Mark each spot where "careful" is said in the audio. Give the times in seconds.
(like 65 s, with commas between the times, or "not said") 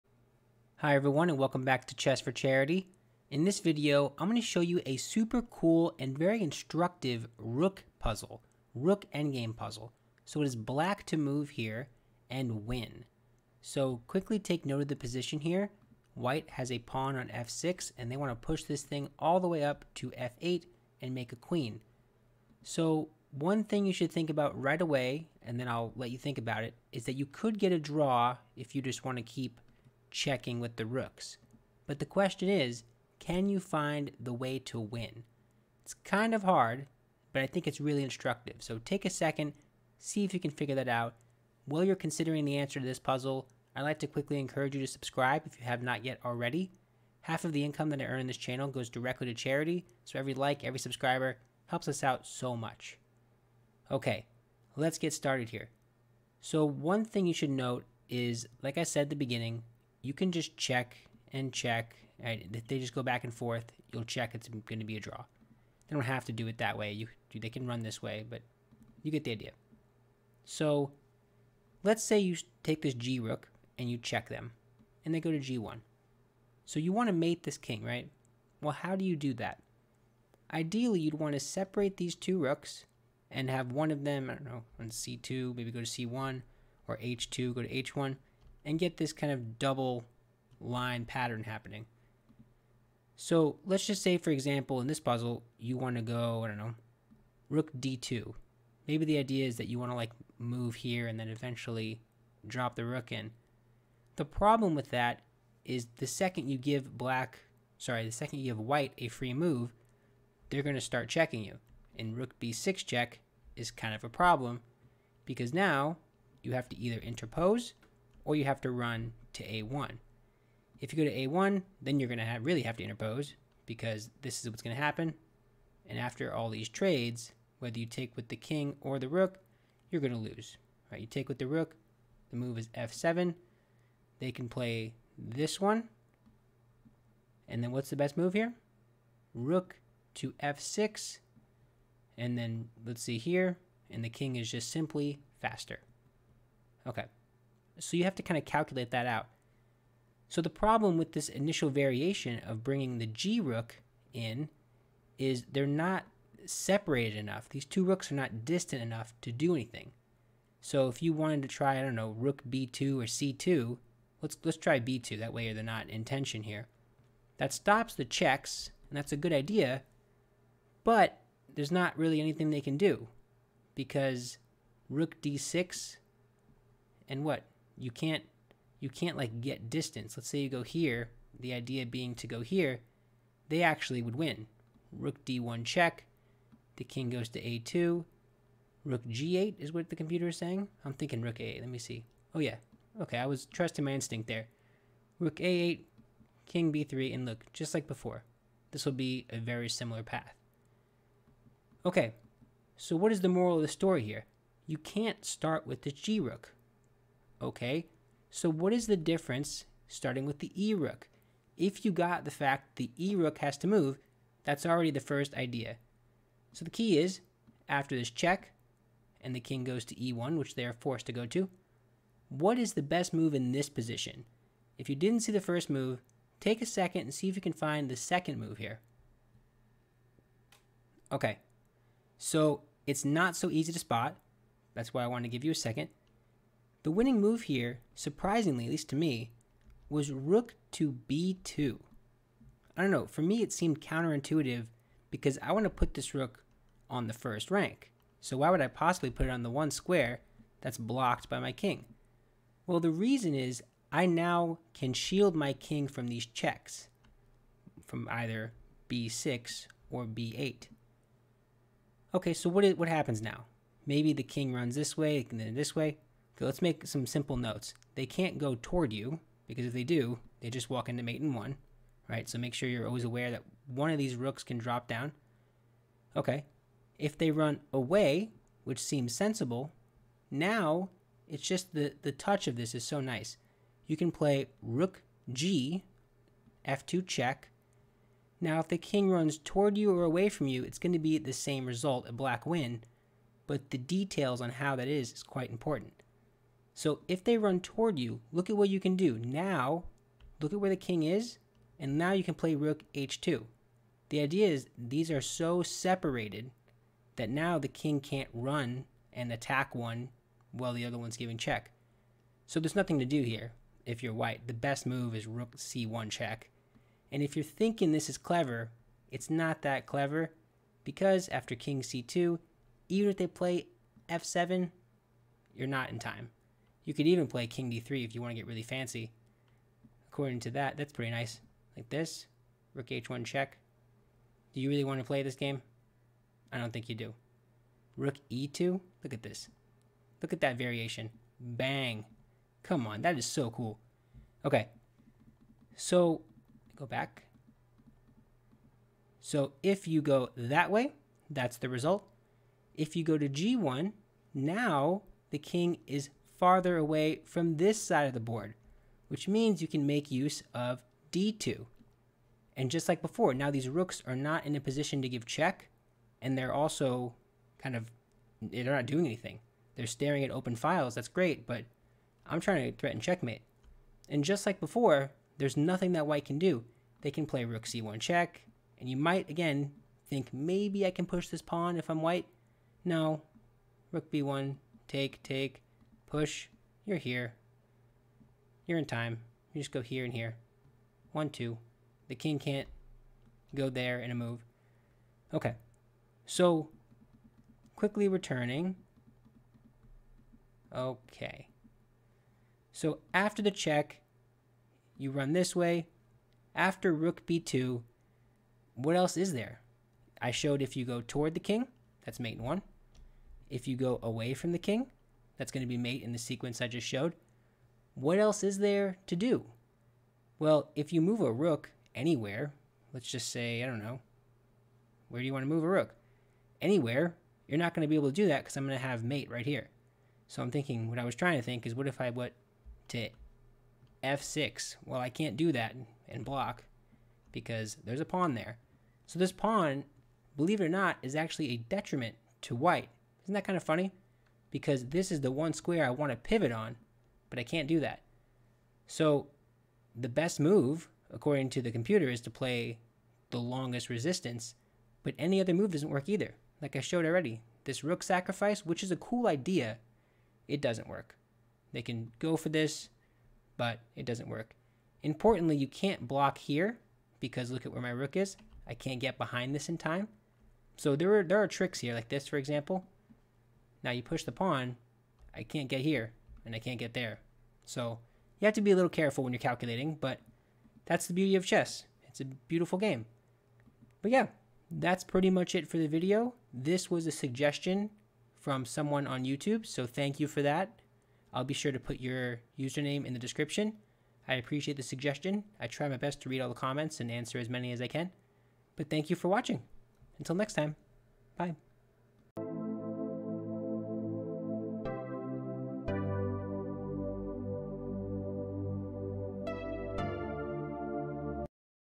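478 s.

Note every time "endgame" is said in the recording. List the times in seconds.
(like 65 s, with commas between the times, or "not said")
9 s.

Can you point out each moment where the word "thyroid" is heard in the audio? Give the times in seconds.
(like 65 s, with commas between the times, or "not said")
not said.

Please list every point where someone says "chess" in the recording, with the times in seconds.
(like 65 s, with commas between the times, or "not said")
1 s, 481 s.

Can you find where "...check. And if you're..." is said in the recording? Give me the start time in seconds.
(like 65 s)
316 s.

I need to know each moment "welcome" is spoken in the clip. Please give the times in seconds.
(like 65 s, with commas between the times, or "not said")
1 s.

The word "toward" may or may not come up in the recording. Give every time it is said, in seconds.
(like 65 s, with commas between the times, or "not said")
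268 s, 289 s, 297 s, 410 s.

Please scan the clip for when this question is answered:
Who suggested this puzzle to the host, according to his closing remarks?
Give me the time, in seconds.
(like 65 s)
488 s.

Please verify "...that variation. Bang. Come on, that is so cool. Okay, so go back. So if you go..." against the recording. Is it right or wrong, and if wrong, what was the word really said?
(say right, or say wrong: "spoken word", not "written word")
right.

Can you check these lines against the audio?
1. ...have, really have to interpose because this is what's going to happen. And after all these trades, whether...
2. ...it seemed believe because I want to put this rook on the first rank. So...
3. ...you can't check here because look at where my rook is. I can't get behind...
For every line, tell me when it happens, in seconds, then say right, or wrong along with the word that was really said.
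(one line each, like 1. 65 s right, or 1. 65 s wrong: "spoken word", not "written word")
1. 122 s right
2. 243 s wrong: "counterintuitive", not "believe"
3. 465 s wrong: "block", not "check".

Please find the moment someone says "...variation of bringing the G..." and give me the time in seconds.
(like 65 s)
151 s.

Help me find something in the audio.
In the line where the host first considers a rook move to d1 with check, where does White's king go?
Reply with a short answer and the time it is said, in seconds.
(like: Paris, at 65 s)
a2, at 187 s.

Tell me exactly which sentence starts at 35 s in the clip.
It's kind of hard, but I think it's really instructive.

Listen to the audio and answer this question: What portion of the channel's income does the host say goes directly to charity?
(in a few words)
Half.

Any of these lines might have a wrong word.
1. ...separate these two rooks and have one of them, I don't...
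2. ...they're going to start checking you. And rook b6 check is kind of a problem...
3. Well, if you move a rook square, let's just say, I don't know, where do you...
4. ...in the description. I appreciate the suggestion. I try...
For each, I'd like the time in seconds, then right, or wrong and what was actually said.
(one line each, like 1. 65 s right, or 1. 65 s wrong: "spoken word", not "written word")
1. 81 s right
2. 110 s right
3. 420 s wrong: "anywhere", not "square"
4. 493 s right.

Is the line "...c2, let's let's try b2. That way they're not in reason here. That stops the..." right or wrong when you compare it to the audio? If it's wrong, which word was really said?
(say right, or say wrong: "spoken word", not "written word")
wrong: "tension", not "reason".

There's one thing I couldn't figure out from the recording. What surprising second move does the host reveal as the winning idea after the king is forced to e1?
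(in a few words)
Rook to b2.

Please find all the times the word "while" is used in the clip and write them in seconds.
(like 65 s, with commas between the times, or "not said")
41 s, 310 s.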